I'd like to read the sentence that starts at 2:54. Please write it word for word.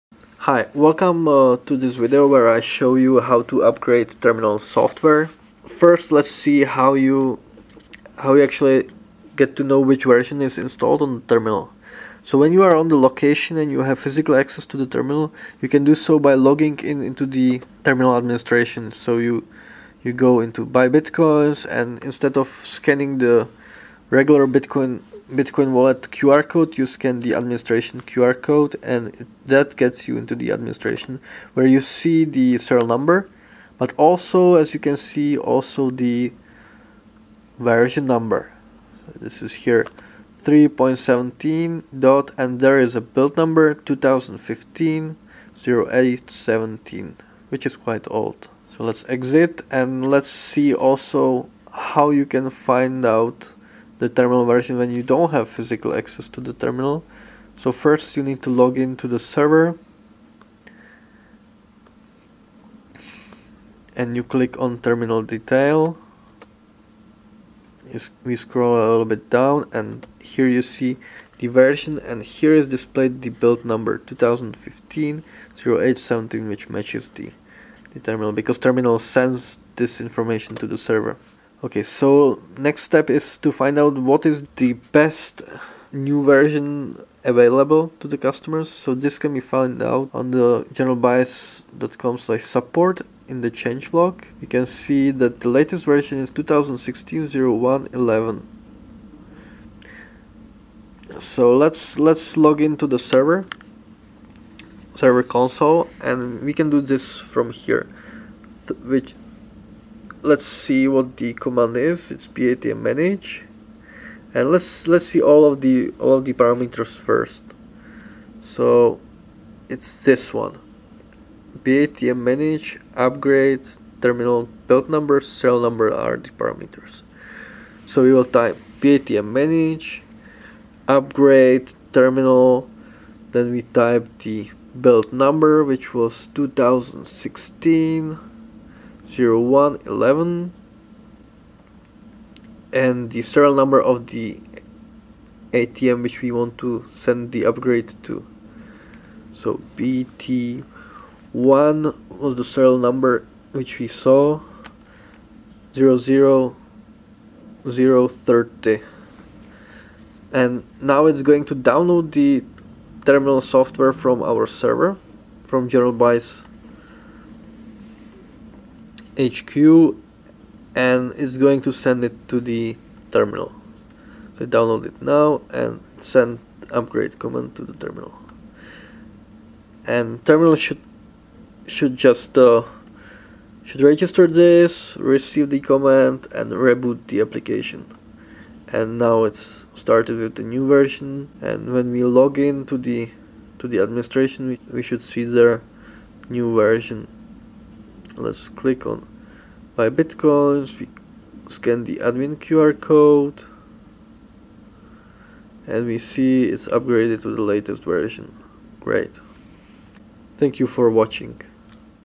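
So download it now and send upgrade command to the terminal.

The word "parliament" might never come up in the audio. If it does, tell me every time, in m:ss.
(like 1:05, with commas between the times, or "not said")
not said.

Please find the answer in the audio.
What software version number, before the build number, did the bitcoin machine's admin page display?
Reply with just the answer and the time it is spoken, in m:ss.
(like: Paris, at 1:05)
3.17, at 0:40.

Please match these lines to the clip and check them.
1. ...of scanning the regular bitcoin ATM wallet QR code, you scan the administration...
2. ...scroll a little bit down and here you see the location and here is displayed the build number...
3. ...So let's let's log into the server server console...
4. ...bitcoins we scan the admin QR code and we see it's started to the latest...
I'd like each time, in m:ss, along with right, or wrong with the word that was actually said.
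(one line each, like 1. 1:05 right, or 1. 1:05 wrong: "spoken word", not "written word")
1. 0:22 wrong: "Bitcoin", not "ATM"
2. 1:08 wrong: "version", not "location"
3. 1:41 right
4. 3:19 wrong: "upgraded", not "started".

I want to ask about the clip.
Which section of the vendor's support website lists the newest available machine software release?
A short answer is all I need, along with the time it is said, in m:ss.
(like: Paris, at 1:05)
change log, at 1:33.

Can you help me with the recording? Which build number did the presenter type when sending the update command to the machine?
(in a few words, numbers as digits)
2016 0111.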